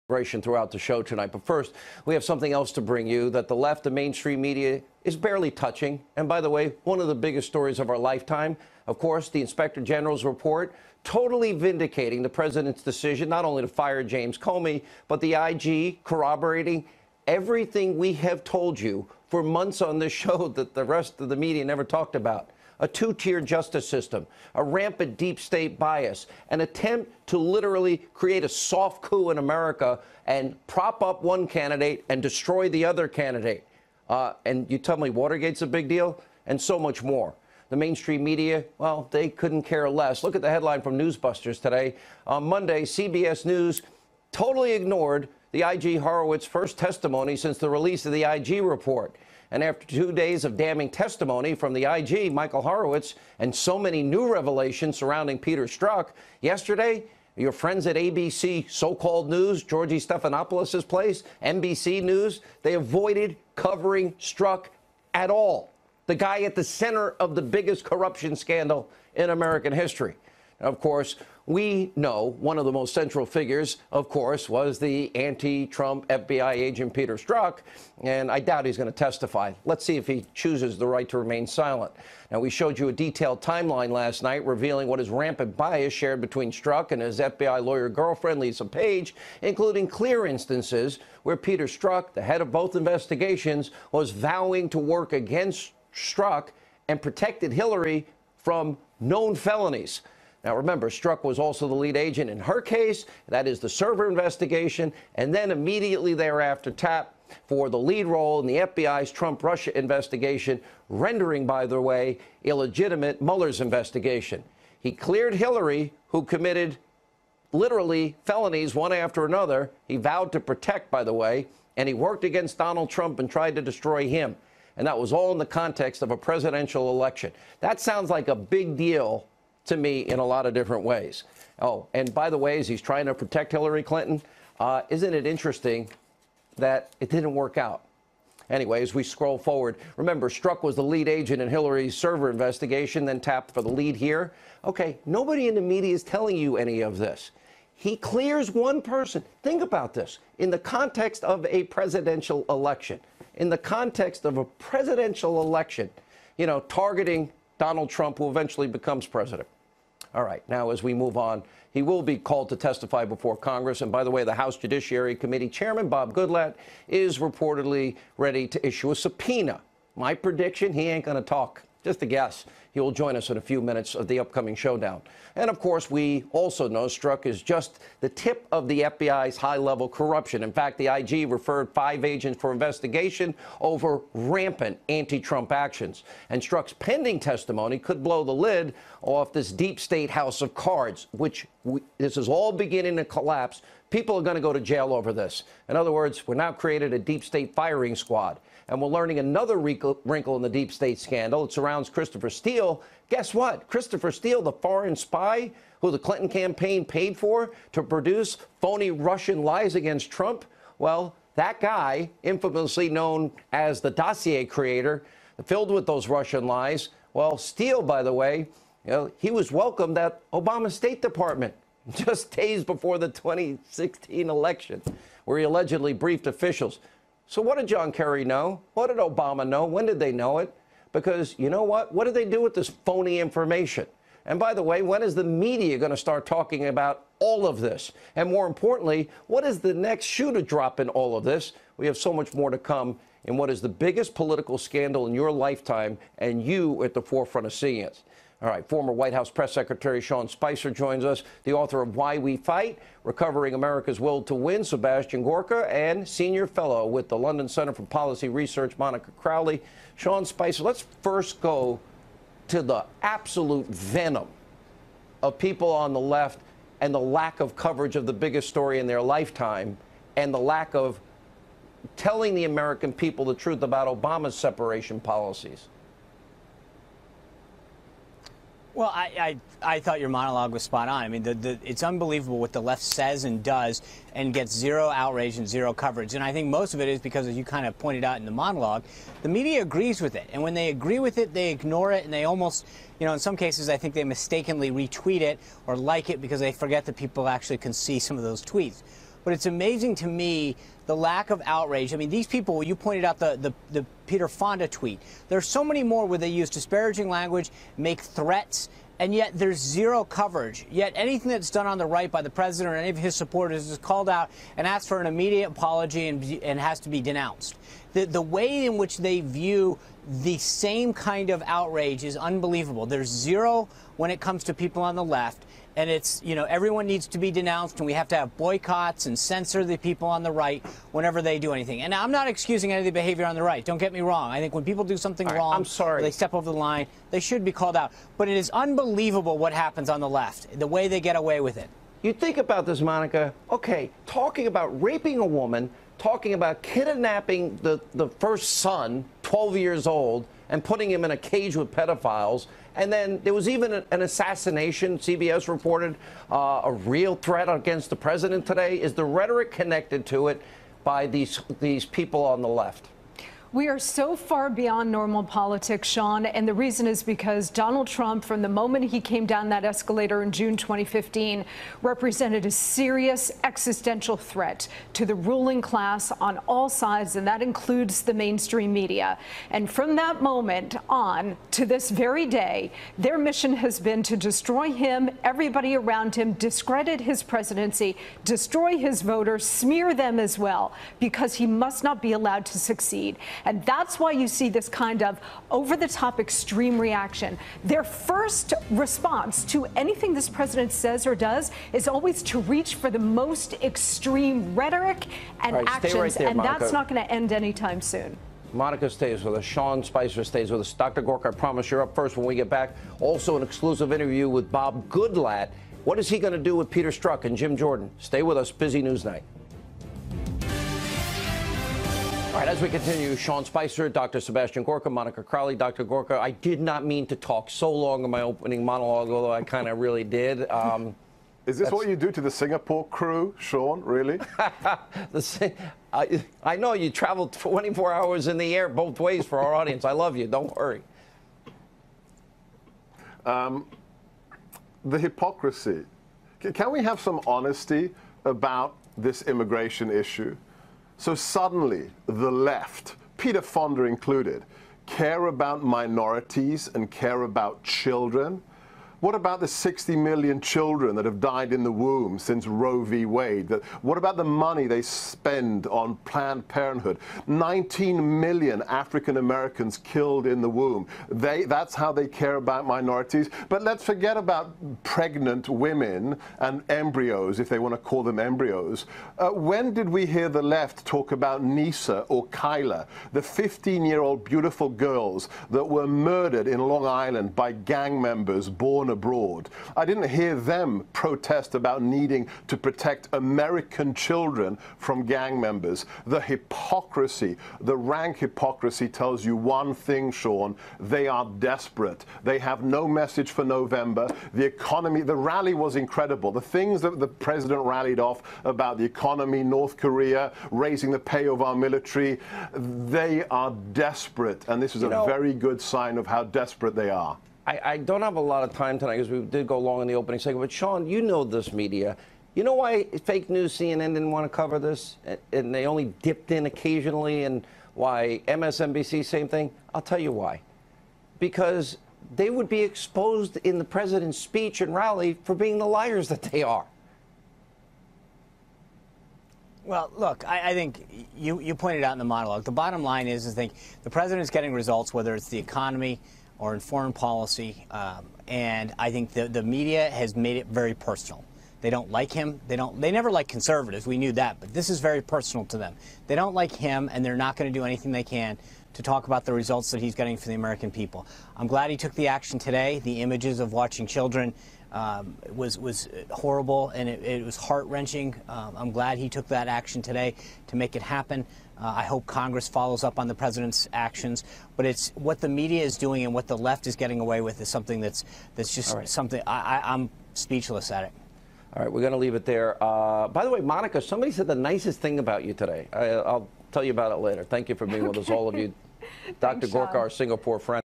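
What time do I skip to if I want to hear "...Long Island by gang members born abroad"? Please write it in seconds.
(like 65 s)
486 s.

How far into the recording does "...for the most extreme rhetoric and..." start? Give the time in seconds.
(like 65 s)
402 s.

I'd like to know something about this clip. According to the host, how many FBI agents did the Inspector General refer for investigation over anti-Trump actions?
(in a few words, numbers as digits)
5.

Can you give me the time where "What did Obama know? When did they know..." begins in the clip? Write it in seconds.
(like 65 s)
228 s.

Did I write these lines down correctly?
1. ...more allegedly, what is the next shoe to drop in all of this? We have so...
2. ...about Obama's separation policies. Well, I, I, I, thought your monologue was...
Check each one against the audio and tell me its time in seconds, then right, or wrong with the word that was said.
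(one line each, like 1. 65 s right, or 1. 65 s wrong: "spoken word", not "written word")
1. 238 s wrong: "importantly", not "allegedly"
2. 273 s right.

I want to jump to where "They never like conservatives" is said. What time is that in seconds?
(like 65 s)
552 s.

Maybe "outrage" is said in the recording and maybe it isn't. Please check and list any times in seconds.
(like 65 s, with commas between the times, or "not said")
284 s, 301 s, 321 s.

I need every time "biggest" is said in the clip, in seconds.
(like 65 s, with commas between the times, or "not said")
7 s, 67 s, 243 s, 268 s.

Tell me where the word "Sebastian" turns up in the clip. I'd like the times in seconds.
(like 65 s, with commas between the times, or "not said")
254 s, 424 s.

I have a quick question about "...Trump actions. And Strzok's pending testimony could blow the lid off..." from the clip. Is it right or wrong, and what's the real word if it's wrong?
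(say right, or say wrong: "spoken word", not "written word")
right.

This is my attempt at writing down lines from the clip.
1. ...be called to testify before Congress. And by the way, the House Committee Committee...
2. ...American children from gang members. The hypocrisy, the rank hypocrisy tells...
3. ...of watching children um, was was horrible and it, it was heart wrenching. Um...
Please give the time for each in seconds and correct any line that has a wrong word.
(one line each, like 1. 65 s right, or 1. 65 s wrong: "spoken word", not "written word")
1. 162 s wrong: "Judiciary", not "Committee"
2. 493 s right
3. 563 s right.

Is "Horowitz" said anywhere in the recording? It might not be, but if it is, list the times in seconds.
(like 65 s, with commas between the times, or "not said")
45 s, 52 s.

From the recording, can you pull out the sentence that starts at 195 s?
In other words, we're now created a deep state firing squad.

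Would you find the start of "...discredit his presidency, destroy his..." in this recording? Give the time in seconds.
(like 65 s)
386 s.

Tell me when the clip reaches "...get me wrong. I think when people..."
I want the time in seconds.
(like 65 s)
333 s.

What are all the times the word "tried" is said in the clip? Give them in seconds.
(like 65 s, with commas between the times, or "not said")
123 s.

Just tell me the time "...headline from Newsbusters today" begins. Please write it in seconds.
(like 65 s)
40 s.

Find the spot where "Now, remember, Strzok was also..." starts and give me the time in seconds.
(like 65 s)
100 s.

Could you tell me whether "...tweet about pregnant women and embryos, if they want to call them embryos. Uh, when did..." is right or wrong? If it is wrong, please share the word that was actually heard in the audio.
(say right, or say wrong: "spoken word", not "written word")
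wrong: "forget", not "tweet".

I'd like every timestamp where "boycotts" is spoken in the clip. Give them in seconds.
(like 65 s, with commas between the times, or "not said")
328 s.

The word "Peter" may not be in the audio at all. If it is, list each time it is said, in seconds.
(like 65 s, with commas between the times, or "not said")
55 s, 76 s, 91 s, 304 s, 416 s, 453 s.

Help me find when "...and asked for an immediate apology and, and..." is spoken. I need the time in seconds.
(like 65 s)
314 s.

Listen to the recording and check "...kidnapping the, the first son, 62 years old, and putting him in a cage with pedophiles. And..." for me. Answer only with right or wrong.
wrong.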